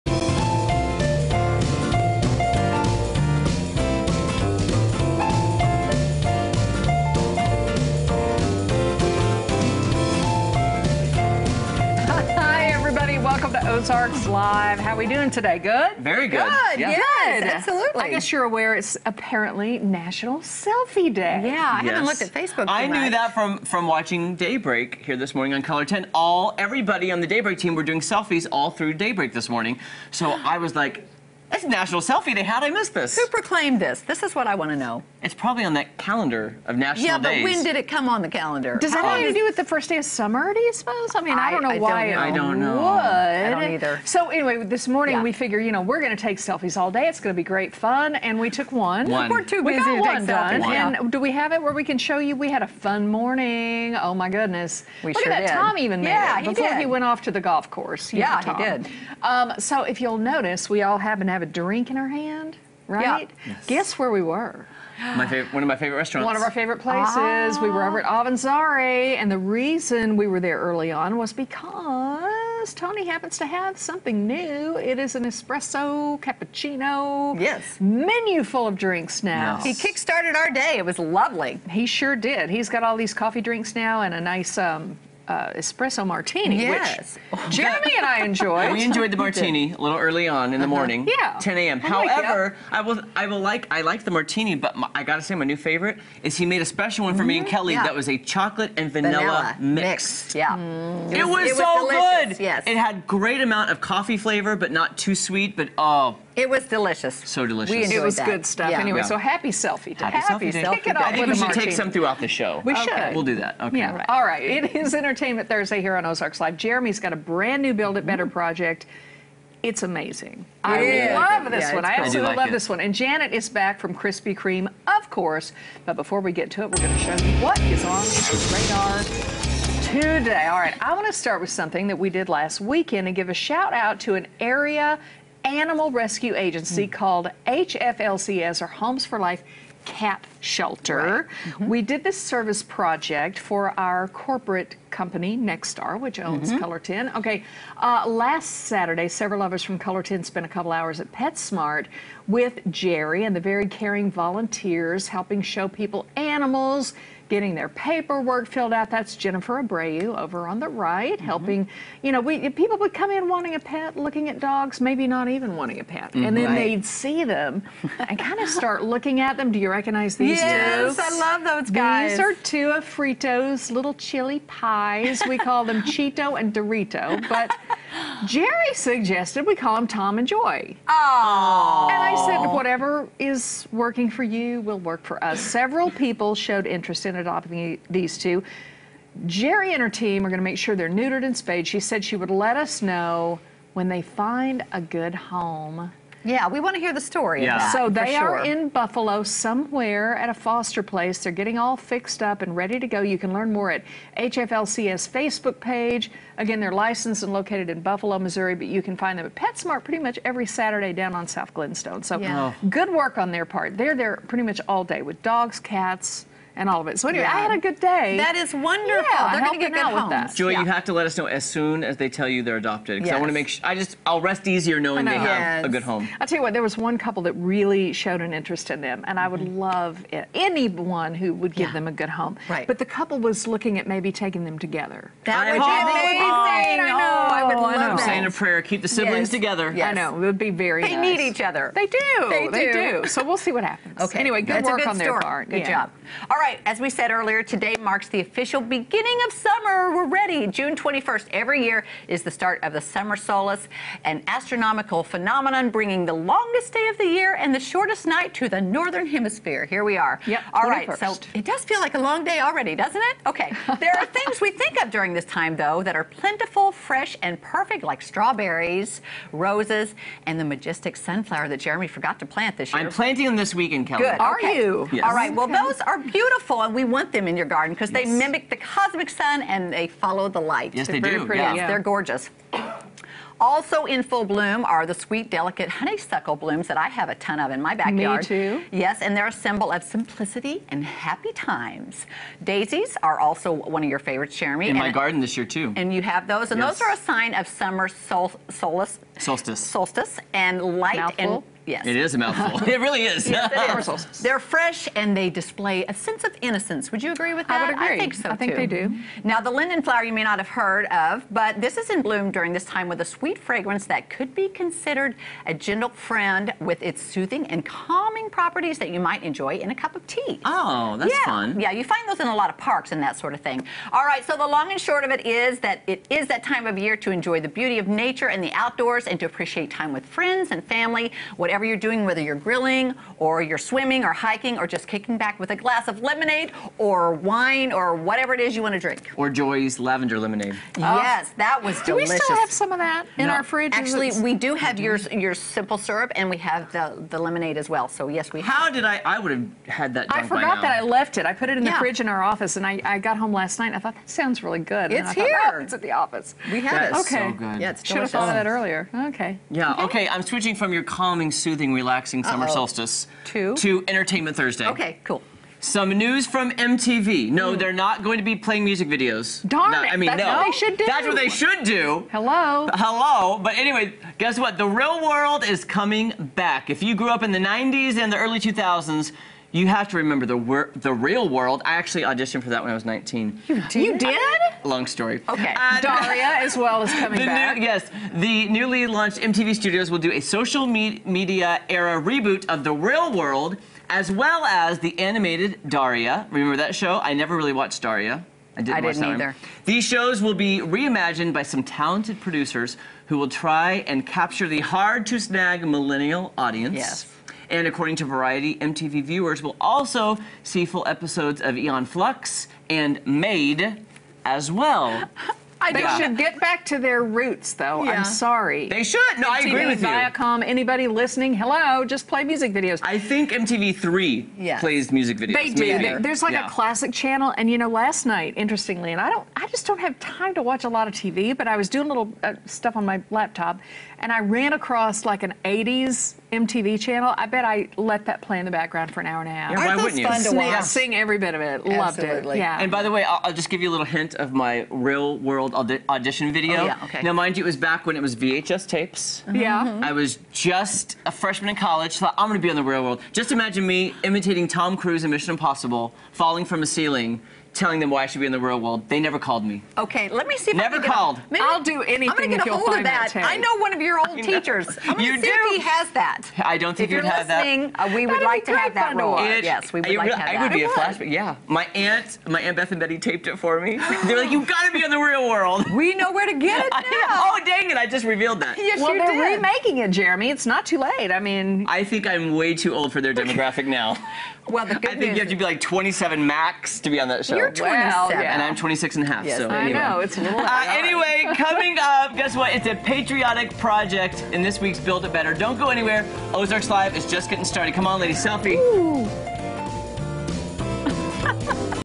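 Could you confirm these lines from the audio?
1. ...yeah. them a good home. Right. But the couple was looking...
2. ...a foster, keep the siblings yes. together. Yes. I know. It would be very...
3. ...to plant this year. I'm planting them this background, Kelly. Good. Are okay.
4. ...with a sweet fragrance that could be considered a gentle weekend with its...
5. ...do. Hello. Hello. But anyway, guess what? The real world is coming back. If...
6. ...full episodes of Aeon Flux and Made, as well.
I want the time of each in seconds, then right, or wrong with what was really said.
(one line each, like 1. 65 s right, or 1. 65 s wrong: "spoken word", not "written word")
1. 231 s right
2. 238 s wrong: "prayer", not "foster"
3. 272 s wrong: "weekend", not "background"
4. 312 s wrong: "friend", not "weekend"
5. 371 s right
6. 410 s right.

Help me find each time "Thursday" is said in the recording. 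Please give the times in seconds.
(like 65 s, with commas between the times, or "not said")
115 s, 364 s.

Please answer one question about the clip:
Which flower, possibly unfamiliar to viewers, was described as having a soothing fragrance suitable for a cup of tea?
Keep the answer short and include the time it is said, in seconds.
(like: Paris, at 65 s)
Linden flower, at 309 s.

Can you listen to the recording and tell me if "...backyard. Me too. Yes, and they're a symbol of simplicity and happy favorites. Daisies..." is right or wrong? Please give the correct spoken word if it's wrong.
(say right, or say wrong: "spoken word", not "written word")
wrong: "times", not "favorites".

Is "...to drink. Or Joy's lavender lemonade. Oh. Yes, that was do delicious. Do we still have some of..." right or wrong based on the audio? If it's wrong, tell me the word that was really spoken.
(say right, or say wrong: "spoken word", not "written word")
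right.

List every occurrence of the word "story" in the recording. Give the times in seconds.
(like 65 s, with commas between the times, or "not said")
197 s, 244 s, 384 s.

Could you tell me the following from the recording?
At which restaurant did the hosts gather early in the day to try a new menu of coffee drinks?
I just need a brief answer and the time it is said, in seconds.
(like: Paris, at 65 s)
Avanzare, at 68 s.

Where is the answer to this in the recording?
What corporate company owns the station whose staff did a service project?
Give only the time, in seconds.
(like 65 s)
145 s.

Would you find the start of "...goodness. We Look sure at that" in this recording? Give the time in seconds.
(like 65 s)
54 s.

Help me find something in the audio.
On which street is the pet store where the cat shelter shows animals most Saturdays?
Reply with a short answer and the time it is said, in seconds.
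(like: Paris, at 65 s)
South Glenstone, at 211 s.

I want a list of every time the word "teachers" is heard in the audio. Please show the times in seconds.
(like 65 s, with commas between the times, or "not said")
464 s.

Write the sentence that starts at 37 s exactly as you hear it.
Yeah, but when did it come on the calendar?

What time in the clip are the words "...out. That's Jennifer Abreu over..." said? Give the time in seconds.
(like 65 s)
158 s.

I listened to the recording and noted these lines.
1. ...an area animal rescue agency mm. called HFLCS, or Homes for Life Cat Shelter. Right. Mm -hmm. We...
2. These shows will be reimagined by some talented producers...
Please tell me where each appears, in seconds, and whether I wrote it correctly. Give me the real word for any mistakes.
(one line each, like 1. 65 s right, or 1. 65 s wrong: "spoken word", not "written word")
1. 134 s right
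2. 399 s right.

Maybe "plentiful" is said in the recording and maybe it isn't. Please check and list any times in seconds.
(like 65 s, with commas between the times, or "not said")
266 s.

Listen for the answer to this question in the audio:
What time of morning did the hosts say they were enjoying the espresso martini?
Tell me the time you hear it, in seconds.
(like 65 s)
91 s.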